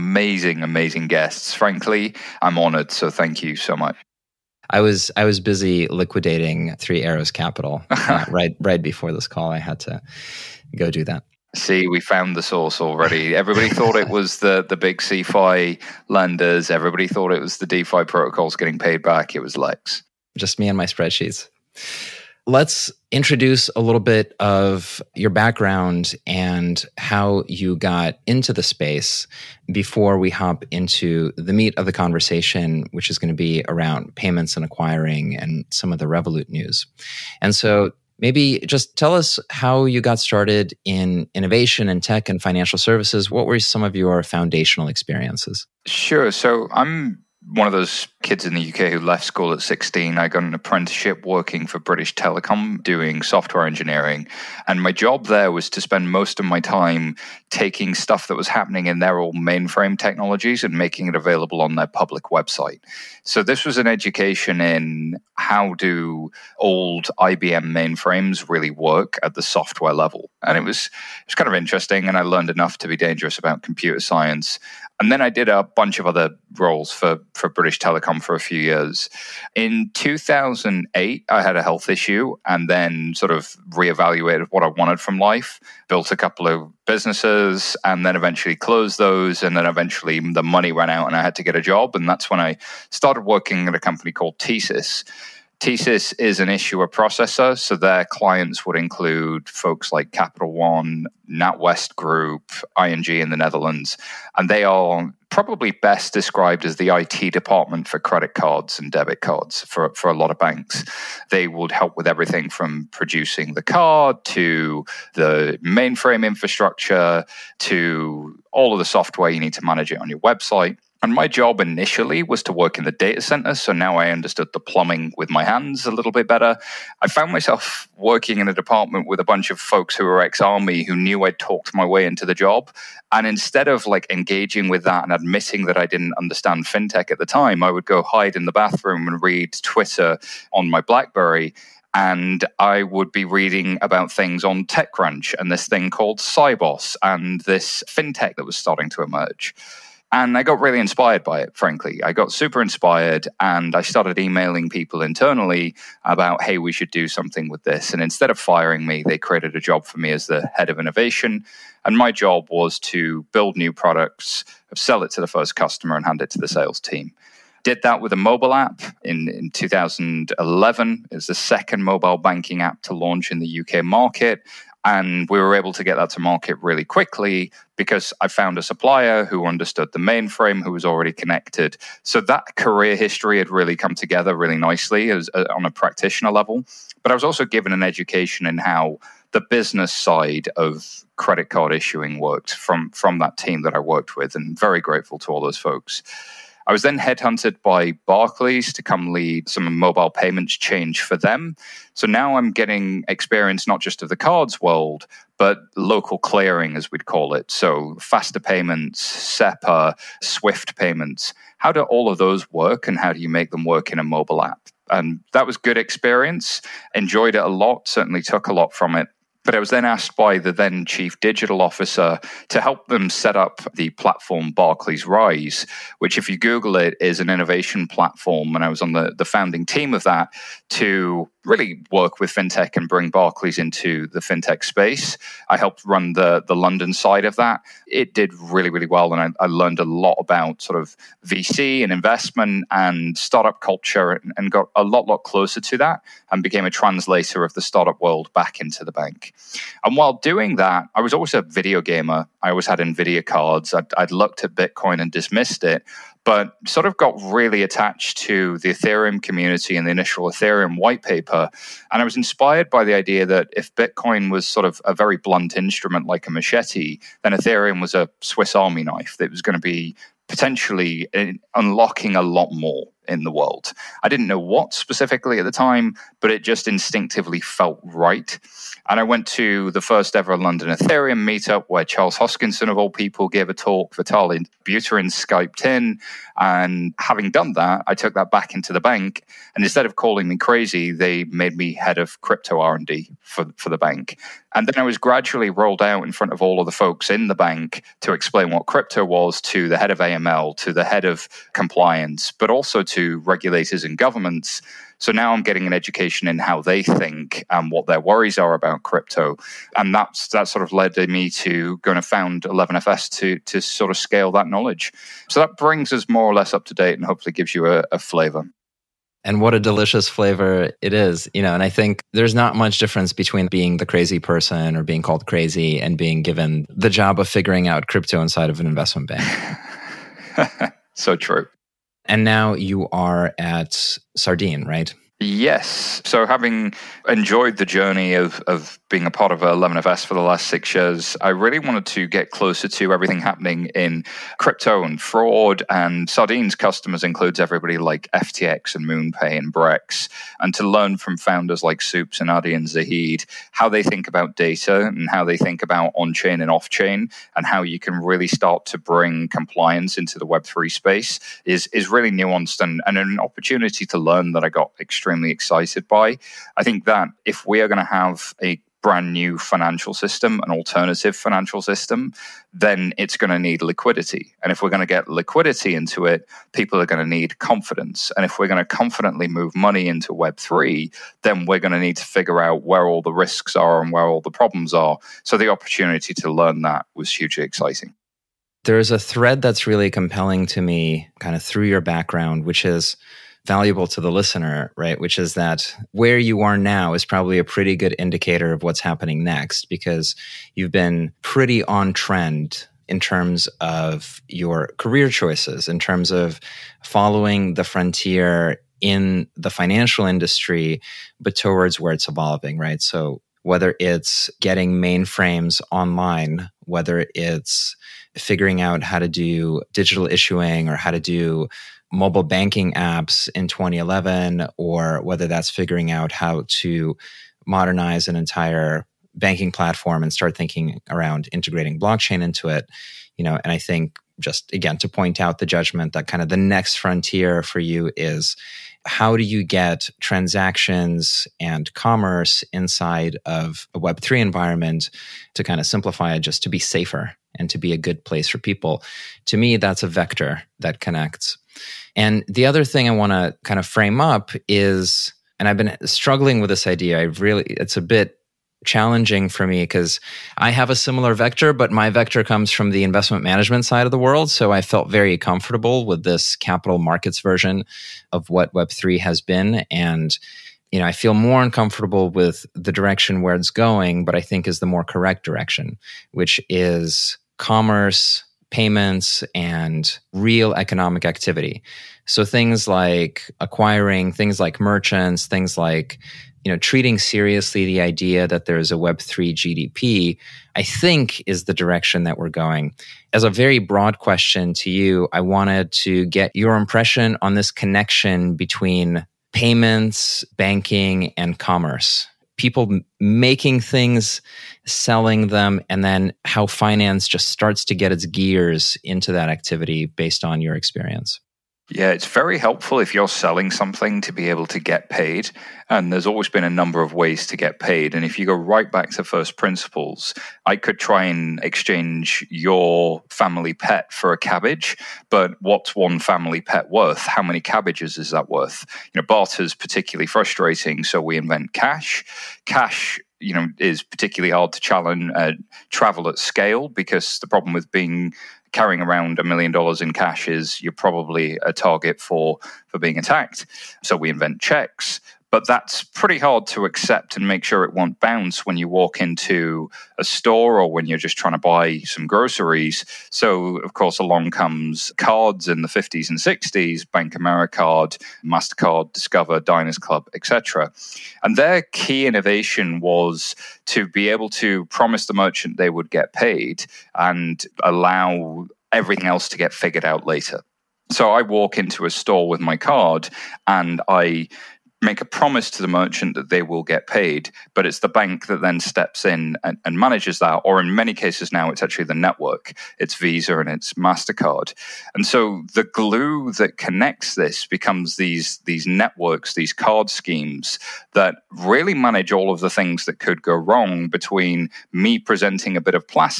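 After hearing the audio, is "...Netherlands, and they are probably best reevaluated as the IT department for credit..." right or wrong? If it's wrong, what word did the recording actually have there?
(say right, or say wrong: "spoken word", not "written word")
wrong: "described", not "reevaluated".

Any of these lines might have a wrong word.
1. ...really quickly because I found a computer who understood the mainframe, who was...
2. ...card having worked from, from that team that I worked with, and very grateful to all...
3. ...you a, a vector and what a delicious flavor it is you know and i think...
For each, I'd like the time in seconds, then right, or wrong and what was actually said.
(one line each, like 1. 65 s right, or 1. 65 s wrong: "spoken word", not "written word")
1. 176 s wrong: "supplier", not "computer"
2. 191 s wrong: "issuing", not "having"
3. 317 s wrong: "flavor", not "vector".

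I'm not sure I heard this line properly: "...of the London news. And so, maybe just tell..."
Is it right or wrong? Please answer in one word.
wrong.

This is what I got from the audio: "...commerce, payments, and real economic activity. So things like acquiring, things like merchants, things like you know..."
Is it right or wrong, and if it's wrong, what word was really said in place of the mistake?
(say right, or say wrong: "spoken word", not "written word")
right.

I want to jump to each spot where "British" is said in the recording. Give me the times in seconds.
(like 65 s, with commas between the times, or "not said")
51 s, 77 s.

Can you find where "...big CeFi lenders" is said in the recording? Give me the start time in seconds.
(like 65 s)
14 s.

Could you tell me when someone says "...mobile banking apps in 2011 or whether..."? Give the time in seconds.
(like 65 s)
421 s.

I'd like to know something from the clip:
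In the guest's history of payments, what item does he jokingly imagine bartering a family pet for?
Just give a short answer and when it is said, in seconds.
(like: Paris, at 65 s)
A cabbage, at 524 s.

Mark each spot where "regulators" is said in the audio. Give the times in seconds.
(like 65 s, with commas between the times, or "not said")
303 s.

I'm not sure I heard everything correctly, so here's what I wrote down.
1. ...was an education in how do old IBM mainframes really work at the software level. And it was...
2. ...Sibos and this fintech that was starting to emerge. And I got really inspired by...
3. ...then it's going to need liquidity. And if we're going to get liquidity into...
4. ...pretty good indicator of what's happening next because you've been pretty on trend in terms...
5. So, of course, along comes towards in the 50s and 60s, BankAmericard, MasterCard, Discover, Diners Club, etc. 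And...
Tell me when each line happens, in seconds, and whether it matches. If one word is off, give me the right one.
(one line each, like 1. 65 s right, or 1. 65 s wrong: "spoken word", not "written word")
1. 63 s right
2. 146 s right
3. 372 s right
4. 397 s right
5. 553 s wrong: "cards", not "towards".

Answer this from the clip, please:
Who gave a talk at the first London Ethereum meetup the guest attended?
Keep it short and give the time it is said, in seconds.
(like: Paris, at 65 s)
Charles Hoskinson, at 281 s.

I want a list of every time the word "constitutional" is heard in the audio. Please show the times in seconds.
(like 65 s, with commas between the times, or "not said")
not said.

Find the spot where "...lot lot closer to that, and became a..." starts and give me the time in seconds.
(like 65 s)
244 s.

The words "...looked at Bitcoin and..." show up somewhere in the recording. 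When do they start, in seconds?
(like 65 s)
254 s.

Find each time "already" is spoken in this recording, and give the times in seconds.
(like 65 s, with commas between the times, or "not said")
12 s, 180 s.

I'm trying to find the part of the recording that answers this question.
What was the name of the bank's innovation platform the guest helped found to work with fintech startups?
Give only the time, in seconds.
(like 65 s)
224 s.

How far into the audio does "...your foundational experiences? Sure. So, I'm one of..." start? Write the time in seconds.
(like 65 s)
43 s.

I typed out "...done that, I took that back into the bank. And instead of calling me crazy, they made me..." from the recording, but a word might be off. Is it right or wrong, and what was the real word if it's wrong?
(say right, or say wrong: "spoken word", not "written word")
right.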